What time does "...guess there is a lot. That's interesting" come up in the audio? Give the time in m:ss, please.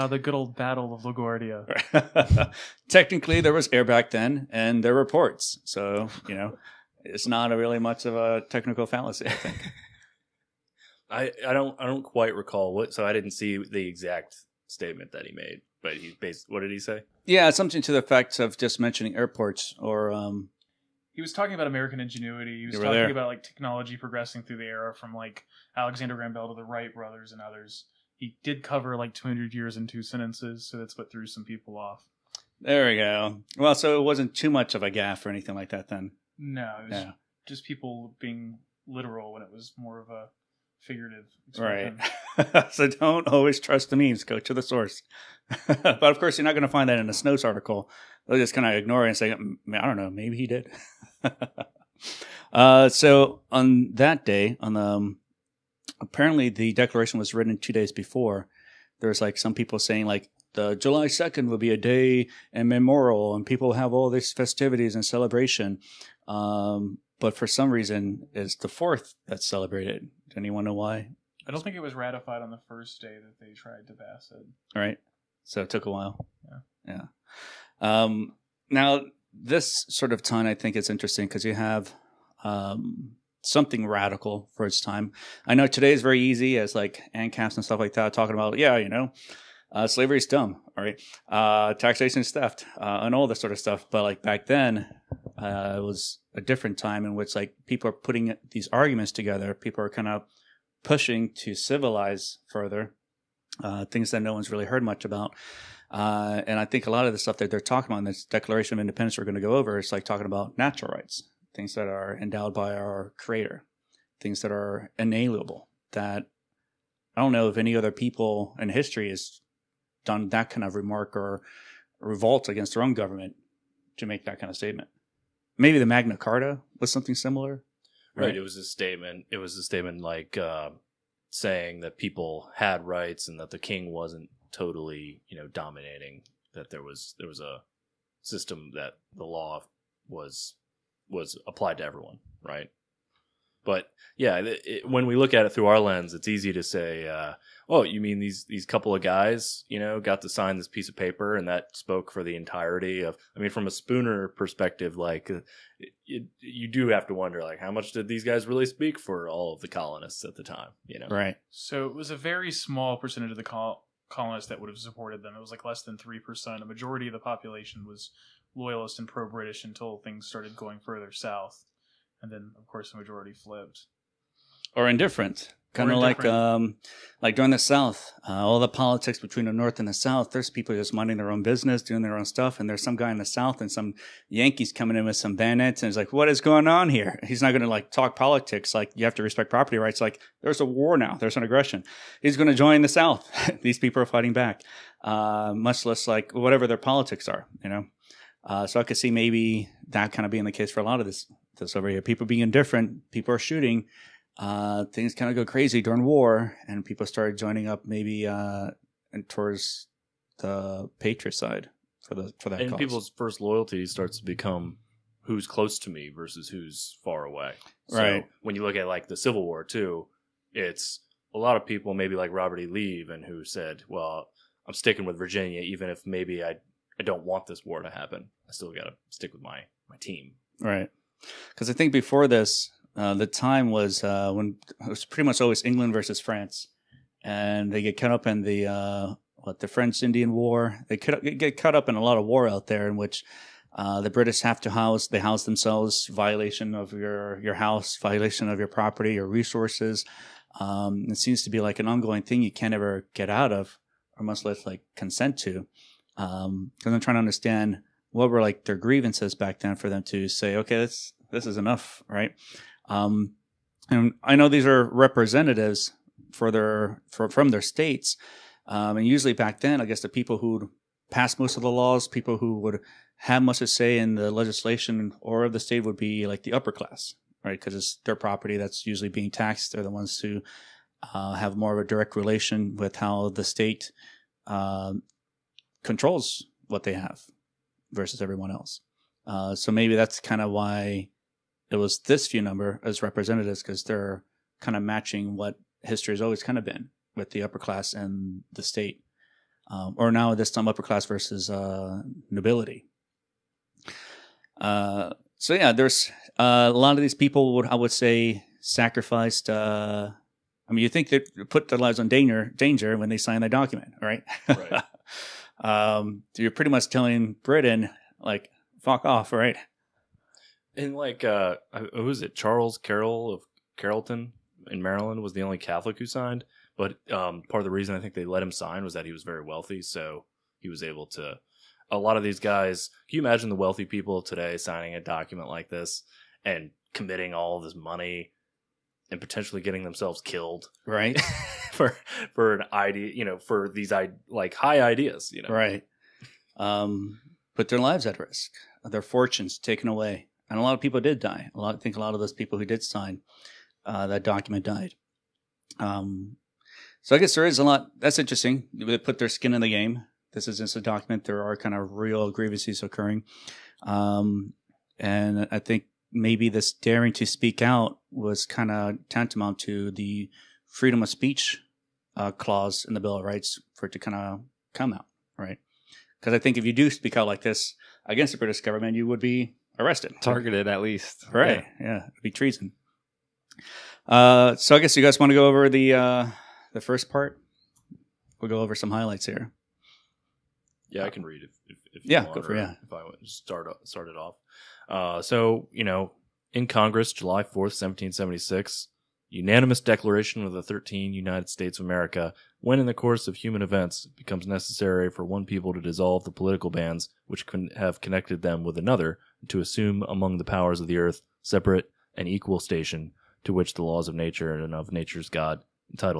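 5:57.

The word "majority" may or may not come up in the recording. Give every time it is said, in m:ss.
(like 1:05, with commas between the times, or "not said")
2:46, 2:52.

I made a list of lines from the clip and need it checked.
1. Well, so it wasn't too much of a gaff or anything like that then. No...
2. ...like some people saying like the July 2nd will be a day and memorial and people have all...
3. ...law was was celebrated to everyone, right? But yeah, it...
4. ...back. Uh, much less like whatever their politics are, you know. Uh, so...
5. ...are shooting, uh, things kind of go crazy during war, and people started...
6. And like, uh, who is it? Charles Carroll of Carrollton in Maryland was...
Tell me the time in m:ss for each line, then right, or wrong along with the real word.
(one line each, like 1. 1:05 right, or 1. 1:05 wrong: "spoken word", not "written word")
1. 0:33 right
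2. 0:59 right
3. 2:19 wrong: "applied", not "celebrated"
4. 3:14 right
5. 3:23 right
6. 5:20 right.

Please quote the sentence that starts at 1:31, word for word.
Uh, taxation is theft uh, and all that sort of stuff.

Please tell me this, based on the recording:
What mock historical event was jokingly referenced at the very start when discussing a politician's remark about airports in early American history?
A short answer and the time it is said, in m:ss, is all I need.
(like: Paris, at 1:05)
Battle of LaGuardia, at 0:00.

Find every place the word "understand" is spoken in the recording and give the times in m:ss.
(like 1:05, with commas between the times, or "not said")
4:17.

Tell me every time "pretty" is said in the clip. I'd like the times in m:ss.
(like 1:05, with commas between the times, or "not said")
3:55, 5:16.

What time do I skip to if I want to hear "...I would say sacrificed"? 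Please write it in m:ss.
5:07.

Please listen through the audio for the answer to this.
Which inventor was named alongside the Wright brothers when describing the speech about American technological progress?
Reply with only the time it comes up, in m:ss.
0:25.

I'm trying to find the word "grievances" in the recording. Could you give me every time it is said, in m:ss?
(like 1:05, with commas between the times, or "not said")
4:18, 6:02.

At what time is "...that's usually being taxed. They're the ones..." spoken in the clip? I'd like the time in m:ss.
4:38.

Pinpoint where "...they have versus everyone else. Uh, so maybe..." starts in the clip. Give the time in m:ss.
4:46.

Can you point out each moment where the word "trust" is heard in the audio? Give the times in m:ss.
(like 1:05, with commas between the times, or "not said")
0:43.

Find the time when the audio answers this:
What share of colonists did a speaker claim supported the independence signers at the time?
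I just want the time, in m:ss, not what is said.
2:45.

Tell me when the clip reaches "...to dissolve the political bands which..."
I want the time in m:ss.
6:45.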